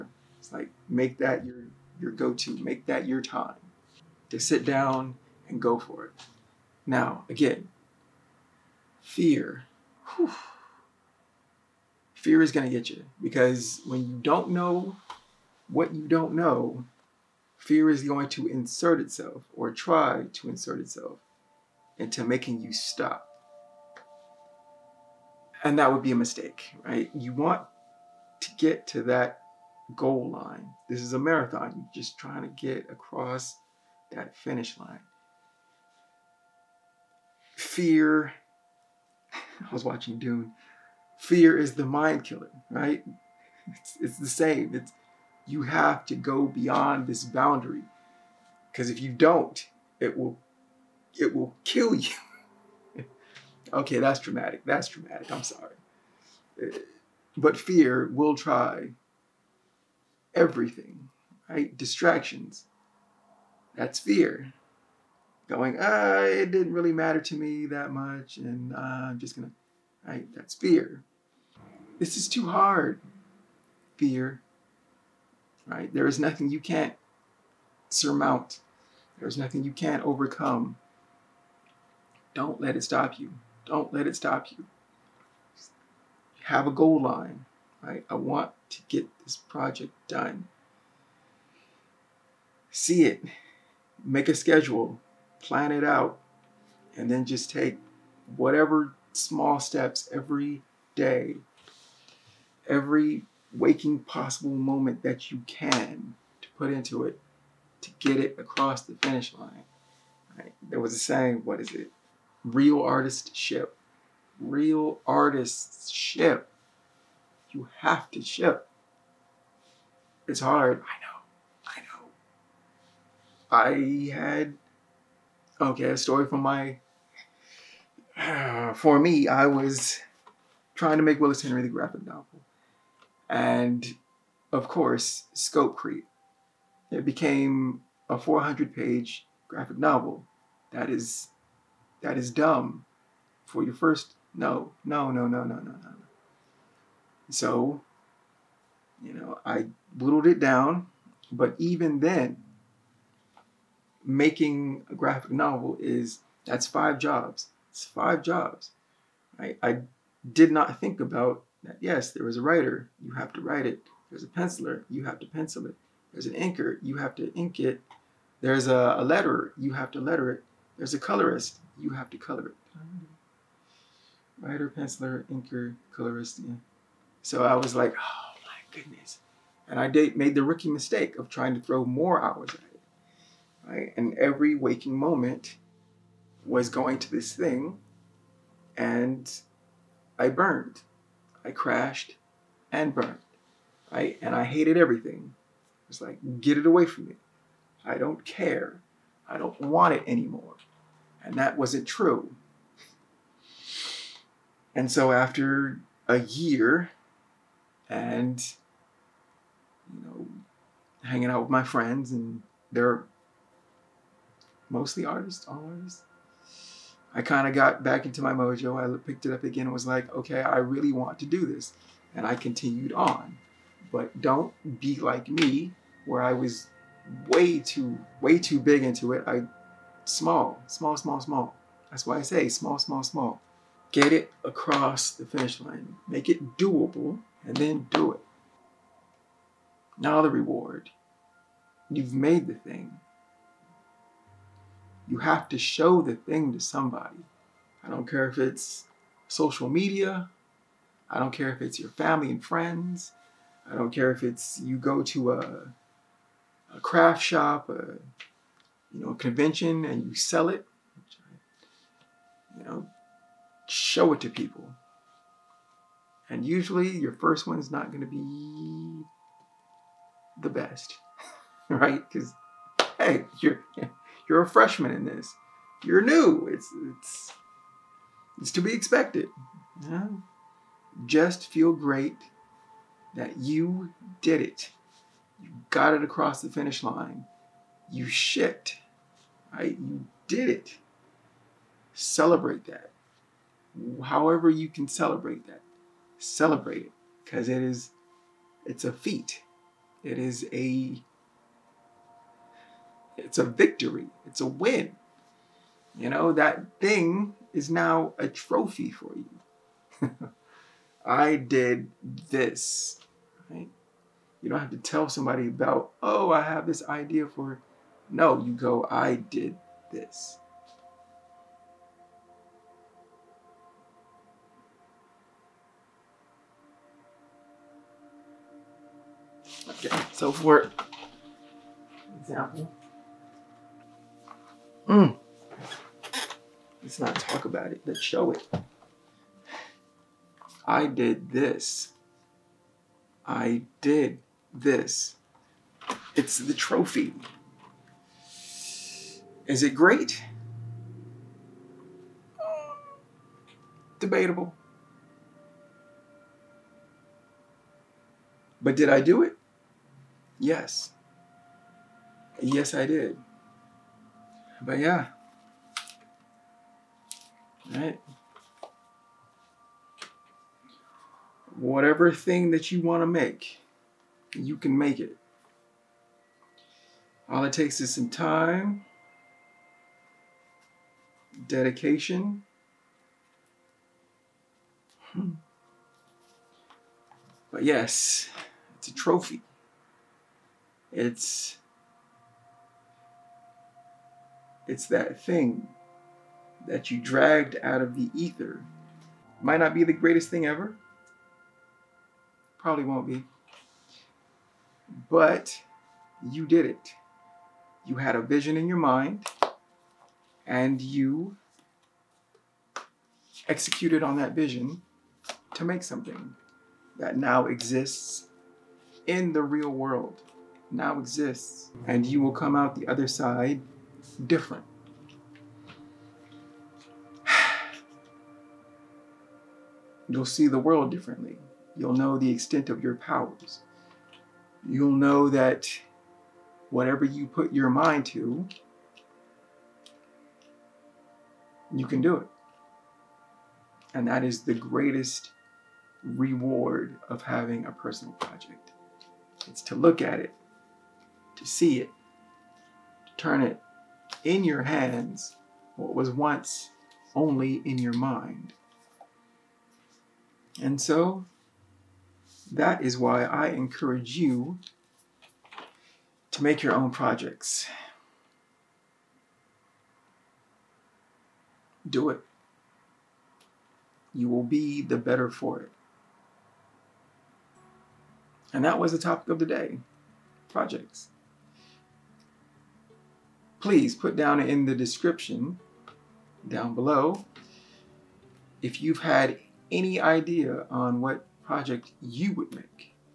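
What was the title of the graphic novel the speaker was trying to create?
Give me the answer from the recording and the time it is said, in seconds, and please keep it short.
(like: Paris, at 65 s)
Willis Henry, at 131 s.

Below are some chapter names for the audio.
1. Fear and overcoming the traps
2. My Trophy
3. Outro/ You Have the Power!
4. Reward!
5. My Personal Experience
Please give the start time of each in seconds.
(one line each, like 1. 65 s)
1. 8 s
2. 328 s
3. 460 s
4. 240 s
5. 128 s.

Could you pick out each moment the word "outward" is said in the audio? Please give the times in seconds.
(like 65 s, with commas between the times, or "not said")
not said.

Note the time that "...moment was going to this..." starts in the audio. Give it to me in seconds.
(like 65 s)
184 s.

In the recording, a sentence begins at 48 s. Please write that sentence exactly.
Because if you don't, it will it will kill you.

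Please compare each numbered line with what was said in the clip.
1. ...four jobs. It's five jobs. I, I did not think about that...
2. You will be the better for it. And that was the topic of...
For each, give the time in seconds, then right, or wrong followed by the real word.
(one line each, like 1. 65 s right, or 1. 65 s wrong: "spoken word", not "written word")
1. 156 s wrong: "five", not "four"
2. 474 s right.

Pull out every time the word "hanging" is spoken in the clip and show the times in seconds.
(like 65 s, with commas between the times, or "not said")
211 s.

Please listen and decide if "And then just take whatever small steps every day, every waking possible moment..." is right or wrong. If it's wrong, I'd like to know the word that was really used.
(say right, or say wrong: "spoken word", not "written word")
right.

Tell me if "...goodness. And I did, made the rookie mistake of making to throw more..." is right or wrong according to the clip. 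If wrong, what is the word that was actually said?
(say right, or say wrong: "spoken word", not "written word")
wrong: "trying", not "making".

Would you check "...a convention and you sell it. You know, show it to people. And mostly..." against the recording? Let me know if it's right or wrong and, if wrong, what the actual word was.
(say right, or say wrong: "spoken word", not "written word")
wrong: "usually", not "mostly".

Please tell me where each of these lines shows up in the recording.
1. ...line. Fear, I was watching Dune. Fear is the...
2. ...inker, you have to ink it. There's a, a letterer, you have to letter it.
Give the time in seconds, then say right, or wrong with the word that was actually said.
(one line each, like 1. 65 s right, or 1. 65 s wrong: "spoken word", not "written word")
1. 34 s right
2. 166 s right.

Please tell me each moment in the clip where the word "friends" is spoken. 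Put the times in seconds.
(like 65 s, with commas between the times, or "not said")
211 s, 252 s.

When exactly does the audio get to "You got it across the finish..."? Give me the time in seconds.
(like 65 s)
285 s.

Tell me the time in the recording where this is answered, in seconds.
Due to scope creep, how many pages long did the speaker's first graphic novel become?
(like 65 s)
138 s.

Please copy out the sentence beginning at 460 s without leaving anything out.
And so, that is why I encourage you to make your own projects.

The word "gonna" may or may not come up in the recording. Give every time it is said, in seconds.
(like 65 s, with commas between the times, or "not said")
69 s.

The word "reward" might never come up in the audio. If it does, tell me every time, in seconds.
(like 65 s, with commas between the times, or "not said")
240 s, 446 s.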